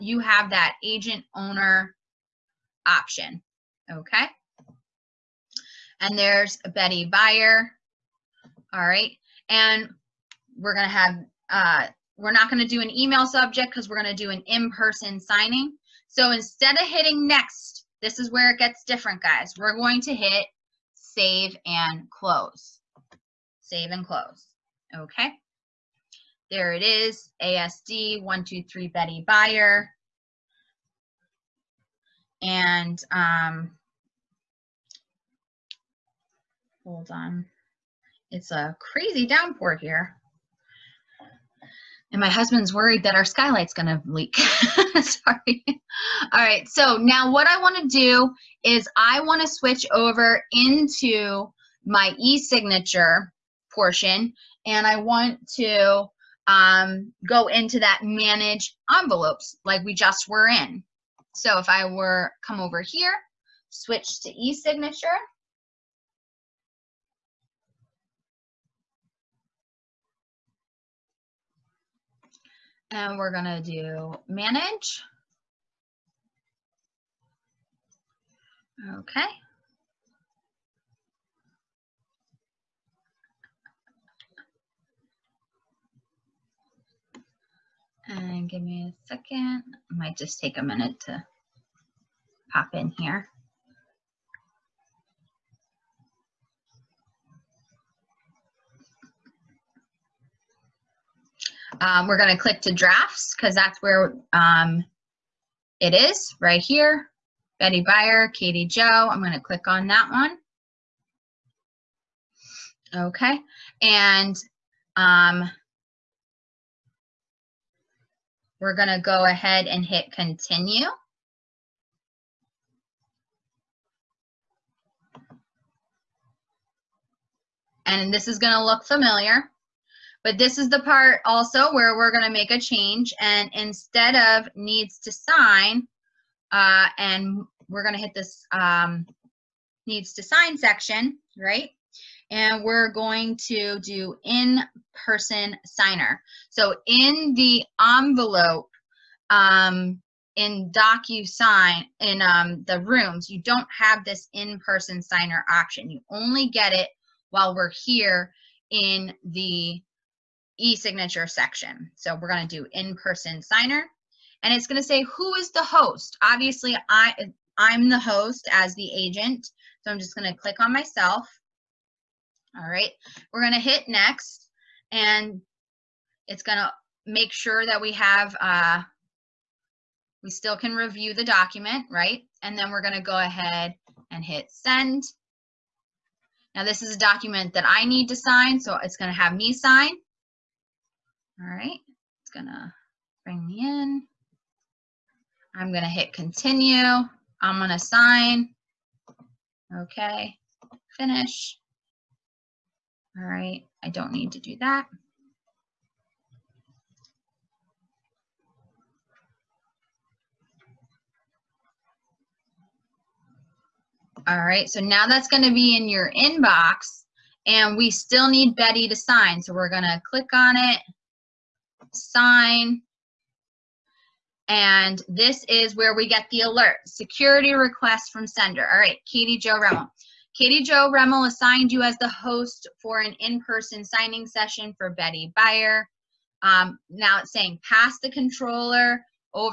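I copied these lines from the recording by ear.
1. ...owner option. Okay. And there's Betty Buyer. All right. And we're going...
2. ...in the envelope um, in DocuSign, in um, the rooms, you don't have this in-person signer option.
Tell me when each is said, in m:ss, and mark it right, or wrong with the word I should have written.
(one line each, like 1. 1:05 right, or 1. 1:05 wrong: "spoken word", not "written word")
1. 0:01 right
2. 2:26 right.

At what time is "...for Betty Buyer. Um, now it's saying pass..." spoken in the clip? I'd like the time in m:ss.
3:54.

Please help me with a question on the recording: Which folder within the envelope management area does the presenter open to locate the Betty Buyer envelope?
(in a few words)
Drafts.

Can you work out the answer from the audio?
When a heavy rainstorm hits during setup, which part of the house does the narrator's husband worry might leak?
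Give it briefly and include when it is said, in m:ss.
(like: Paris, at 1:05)
Skylight, at 0:43.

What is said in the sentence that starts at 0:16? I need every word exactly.
So instead of hitting next, this is where it gets different, guys.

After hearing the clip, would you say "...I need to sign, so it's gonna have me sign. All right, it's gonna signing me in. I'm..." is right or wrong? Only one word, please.
wrong.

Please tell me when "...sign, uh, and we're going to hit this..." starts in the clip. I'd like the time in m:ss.
2:15.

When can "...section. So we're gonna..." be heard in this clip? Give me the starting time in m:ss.
2:41.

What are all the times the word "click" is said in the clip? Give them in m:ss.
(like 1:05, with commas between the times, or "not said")
1:42, 1:49, 2:50, 3:40.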